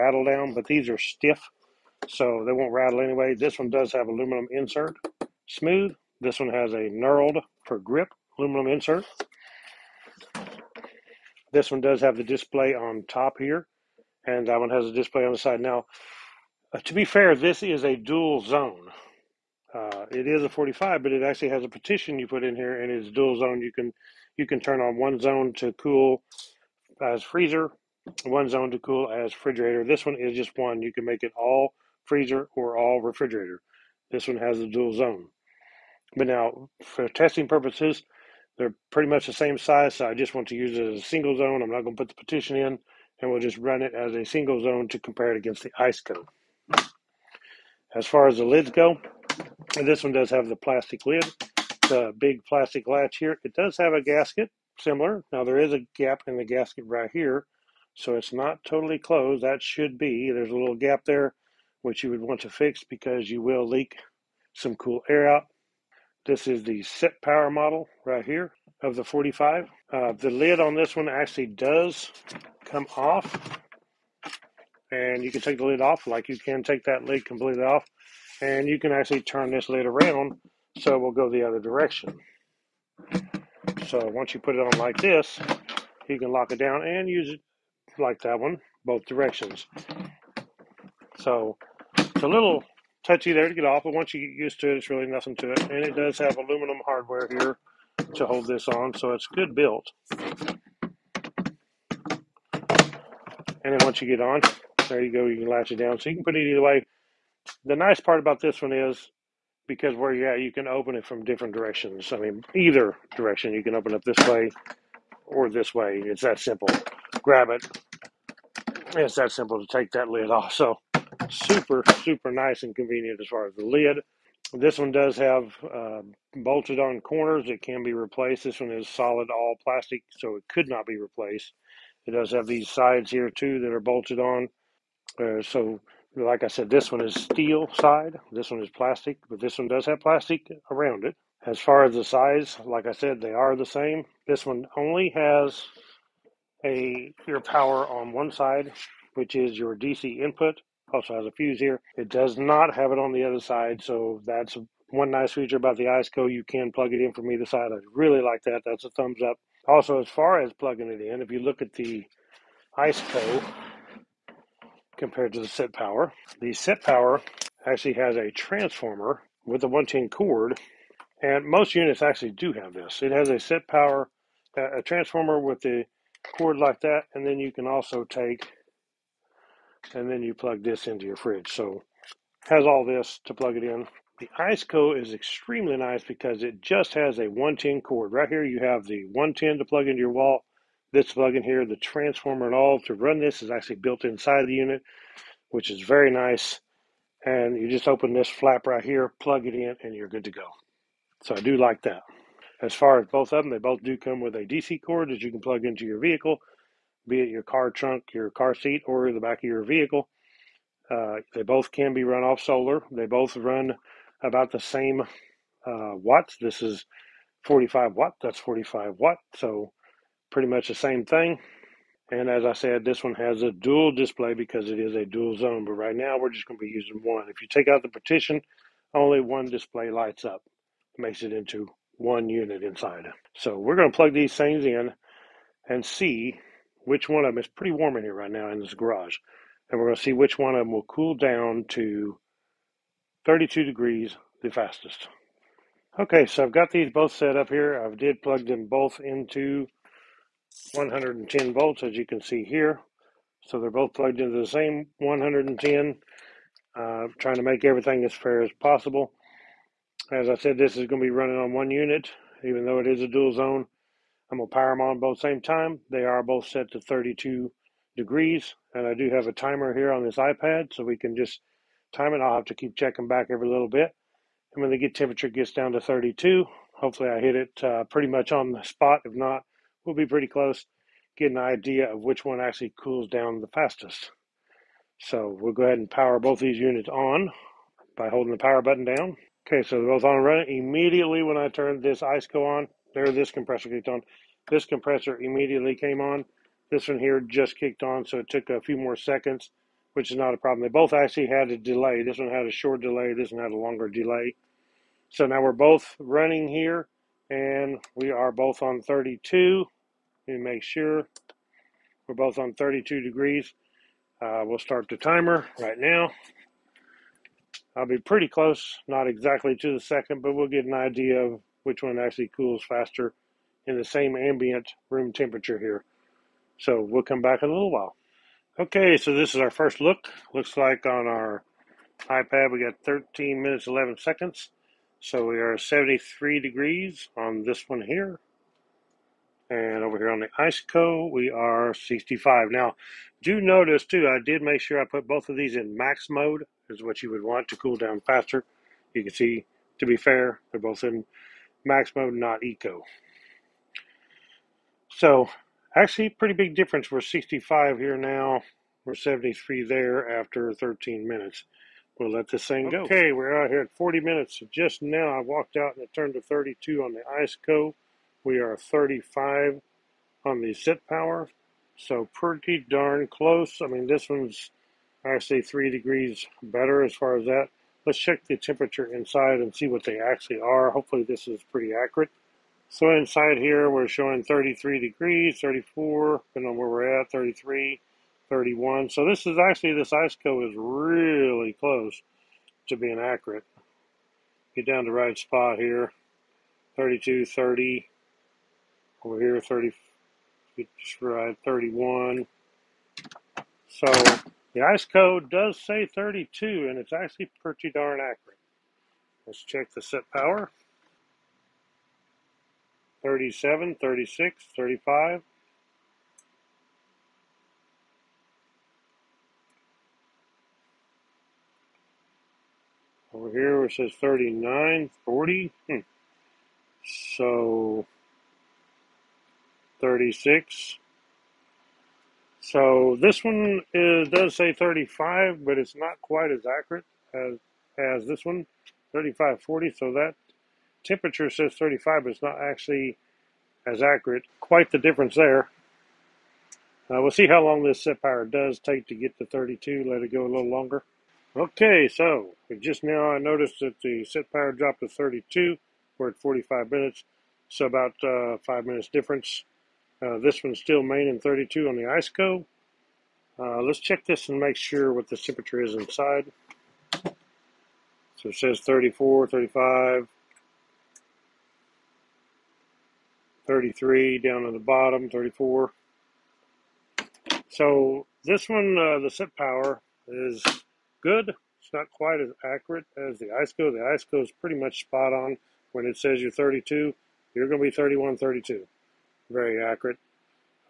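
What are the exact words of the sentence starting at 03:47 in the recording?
If you take out the partition, only one display lights up, makes it into one unit inside.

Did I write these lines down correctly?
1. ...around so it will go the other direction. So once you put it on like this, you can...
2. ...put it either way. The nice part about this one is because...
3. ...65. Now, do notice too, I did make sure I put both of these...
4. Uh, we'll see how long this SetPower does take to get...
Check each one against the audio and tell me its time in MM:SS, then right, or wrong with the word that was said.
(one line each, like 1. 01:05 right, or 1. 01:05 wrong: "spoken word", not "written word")
1. 01:19 right
2. 01:46 right
3. 05:41 right
4. 07:26 right.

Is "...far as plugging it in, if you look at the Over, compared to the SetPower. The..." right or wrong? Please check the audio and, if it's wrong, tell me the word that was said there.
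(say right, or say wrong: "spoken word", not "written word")
wrong: "Iceco", not "Over".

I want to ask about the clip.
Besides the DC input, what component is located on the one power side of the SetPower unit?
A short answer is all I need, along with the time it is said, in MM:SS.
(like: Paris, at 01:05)
fuse, at 02:31.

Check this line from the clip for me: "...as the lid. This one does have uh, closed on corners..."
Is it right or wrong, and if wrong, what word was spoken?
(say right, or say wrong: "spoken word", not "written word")
wrong: "bolted", not "closed".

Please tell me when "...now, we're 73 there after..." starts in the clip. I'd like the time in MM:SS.
05:57.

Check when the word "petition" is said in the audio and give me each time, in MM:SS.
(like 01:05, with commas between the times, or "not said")
00:21, 00:42.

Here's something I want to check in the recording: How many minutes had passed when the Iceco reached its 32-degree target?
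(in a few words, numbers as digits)
40.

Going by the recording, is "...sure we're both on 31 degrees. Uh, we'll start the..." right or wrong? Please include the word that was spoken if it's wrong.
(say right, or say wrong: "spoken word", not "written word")
wrong: "32", not "31".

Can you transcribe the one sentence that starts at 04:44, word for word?
So we'll go ahead and power both these units on by holding the power button down.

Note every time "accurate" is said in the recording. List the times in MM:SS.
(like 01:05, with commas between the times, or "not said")
06:21, 06:32, 06:48, 07:16, 07:23, 08:02, 08:09.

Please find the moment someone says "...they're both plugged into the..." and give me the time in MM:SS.
04:13.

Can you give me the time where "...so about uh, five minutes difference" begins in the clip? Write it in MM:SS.
07:37.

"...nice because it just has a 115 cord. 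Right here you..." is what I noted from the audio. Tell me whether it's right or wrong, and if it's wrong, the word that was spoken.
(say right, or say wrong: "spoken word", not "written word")
wrong: "110", not "115".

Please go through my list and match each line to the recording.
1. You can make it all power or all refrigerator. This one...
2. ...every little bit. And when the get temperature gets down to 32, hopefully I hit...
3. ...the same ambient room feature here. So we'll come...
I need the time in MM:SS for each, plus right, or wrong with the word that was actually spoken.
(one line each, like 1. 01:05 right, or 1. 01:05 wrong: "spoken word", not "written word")
1. 00:30 wrong: "freezer", not "power"
2. 04:33 right
3. 05:23 wrong: "temperature", not "feature".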